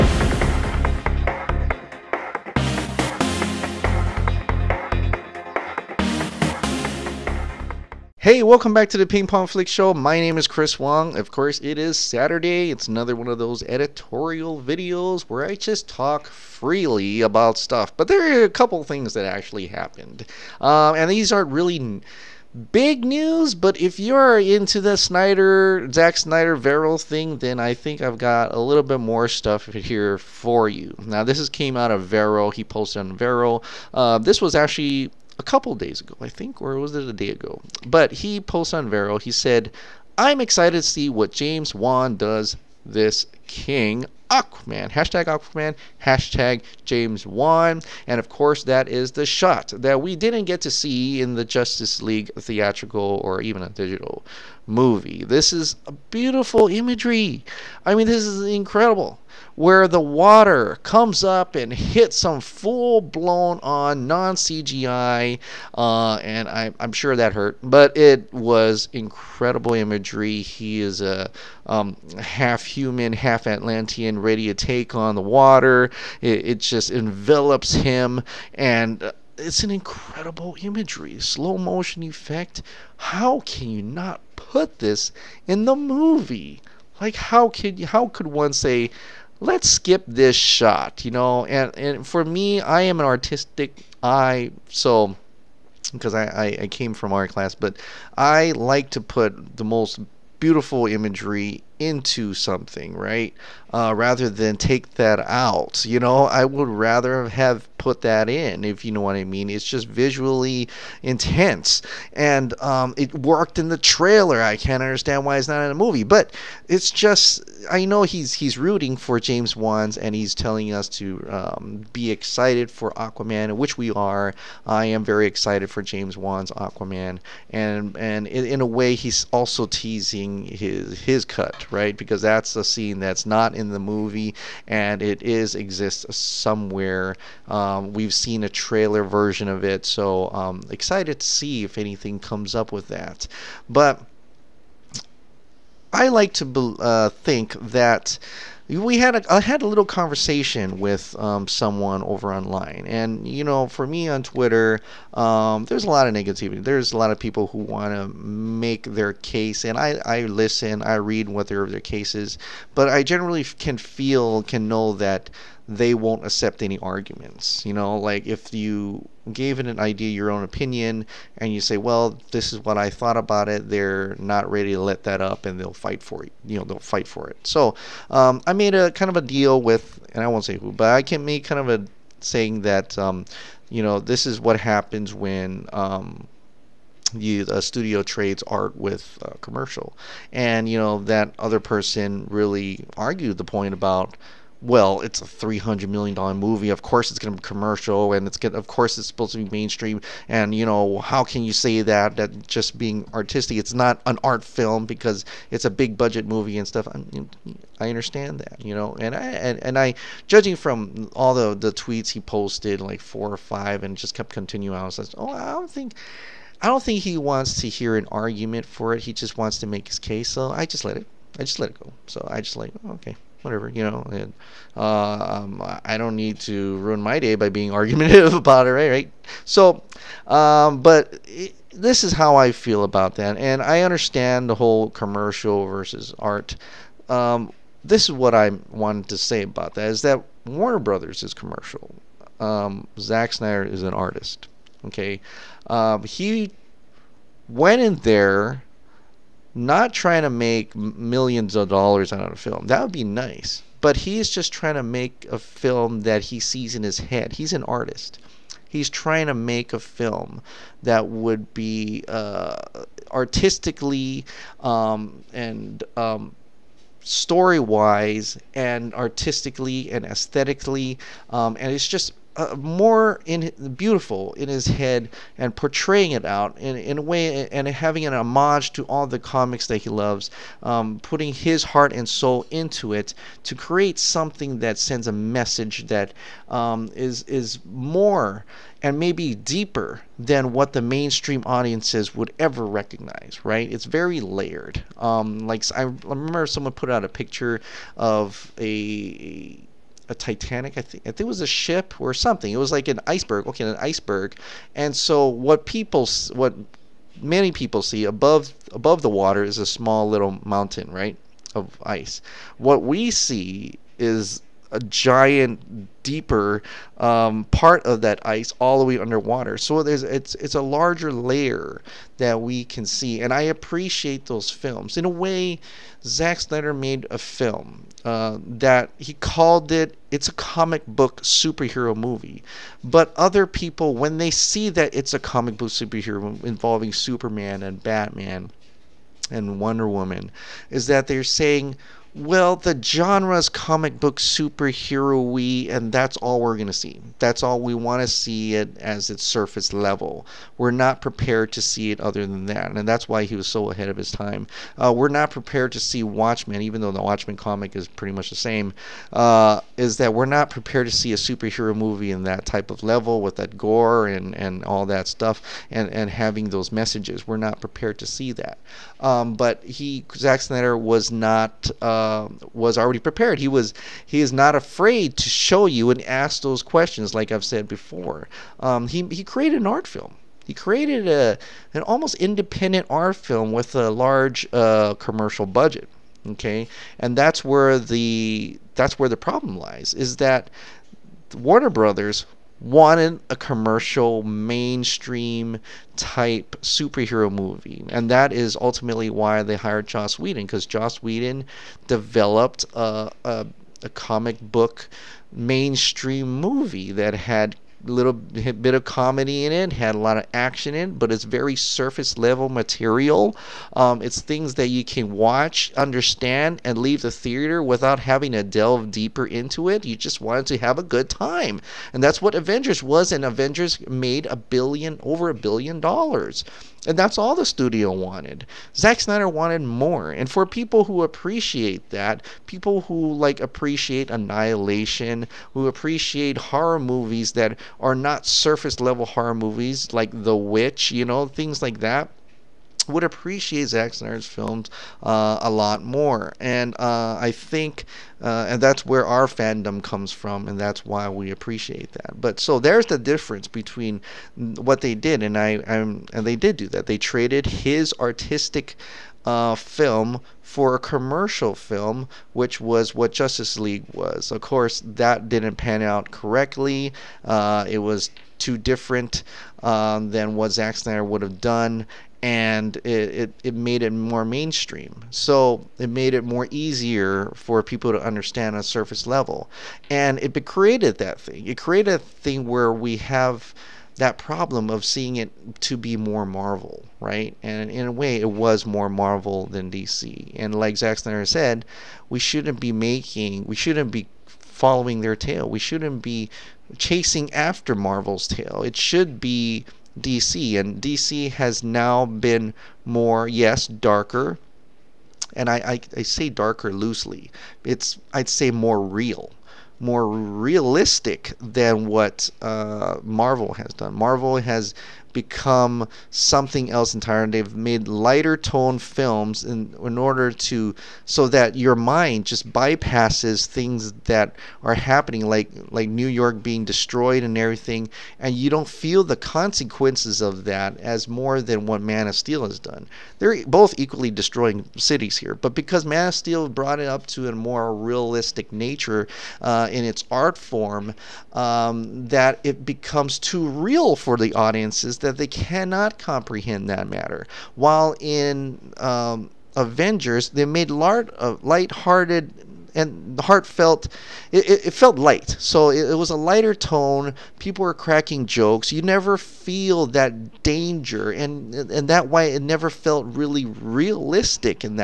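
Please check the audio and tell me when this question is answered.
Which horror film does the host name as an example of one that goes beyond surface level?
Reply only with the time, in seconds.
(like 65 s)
440 s.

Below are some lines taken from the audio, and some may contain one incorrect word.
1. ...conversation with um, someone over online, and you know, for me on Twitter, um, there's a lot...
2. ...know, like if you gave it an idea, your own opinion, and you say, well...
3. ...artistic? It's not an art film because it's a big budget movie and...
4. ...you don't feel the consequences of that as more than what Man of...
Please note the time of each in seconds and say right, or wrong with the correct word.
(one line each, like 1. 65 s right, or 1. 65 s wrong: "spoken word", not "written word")
1. 149 s right
2. 167 s right
3. 203 s right
4. 528 s right.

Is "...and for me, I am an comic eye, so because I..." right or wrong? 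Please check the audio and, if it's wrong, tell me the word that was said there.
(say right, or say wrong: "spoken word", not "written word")
wrong: "artistic", not "comic".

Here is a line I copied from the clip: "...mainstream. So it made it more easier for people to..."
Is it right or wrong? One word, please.
right.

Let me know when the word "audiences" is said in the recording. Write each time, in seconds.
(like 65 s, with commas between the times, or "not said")
291 s, 544 s.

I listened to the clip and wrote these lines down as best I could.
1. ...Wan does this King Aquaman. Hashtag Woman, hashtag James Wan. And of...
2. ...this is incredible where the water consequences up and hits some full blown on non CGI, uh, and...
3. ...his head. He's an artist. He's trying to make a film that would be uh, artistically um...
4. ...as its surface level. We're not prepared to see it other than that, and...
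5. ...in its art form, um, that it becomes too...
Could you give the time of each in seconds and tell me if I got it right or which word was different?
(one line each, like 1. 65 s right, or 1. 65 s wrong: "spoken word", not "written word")
1. 41 s wrong: "Aquaman", not "Woman"
2. 58 s wrong: "comes", not "consequences"
3. 256 s right
4. 348 s right
5. 539 s right.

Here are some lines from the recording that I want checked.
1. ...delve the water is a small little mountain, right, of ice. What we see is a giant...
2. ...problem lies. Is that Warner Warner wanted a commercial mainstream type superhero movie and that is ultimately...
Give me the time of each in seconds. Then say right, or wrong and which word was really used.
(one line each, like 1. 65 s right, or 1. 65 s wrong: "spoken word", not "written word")
1. 308 s wrong: "above", not "delve"
2. 389 s wrong: "Brothers", not "Warner".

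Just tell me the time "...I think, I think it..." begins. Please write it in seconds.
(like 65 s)
300 s.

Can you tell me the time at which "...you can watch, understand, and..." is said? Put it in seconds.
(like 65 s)
414 s.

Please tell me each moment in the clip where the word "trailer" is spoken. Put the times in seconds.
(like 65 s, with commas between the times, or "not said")
113 s, 138 s.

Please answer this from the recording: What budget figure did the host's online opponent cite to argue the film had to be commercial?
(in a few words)
$300 million.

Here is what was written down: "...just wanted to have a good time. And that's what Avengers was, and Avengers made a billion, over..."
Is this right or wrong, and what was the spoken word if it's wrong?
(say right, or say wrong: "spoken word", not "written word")
right.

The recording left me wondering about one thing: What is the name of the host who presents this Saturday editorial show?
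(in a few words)
Chris Wong.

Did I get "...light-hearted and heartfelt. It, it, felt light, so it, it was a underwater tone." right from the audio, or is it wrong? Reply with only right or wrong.
wrong.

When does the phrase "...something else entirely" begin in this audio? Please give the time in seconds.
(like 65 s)
516 s.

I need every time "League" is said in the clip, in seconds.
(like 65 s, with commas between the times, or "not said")
52 s, 463 s.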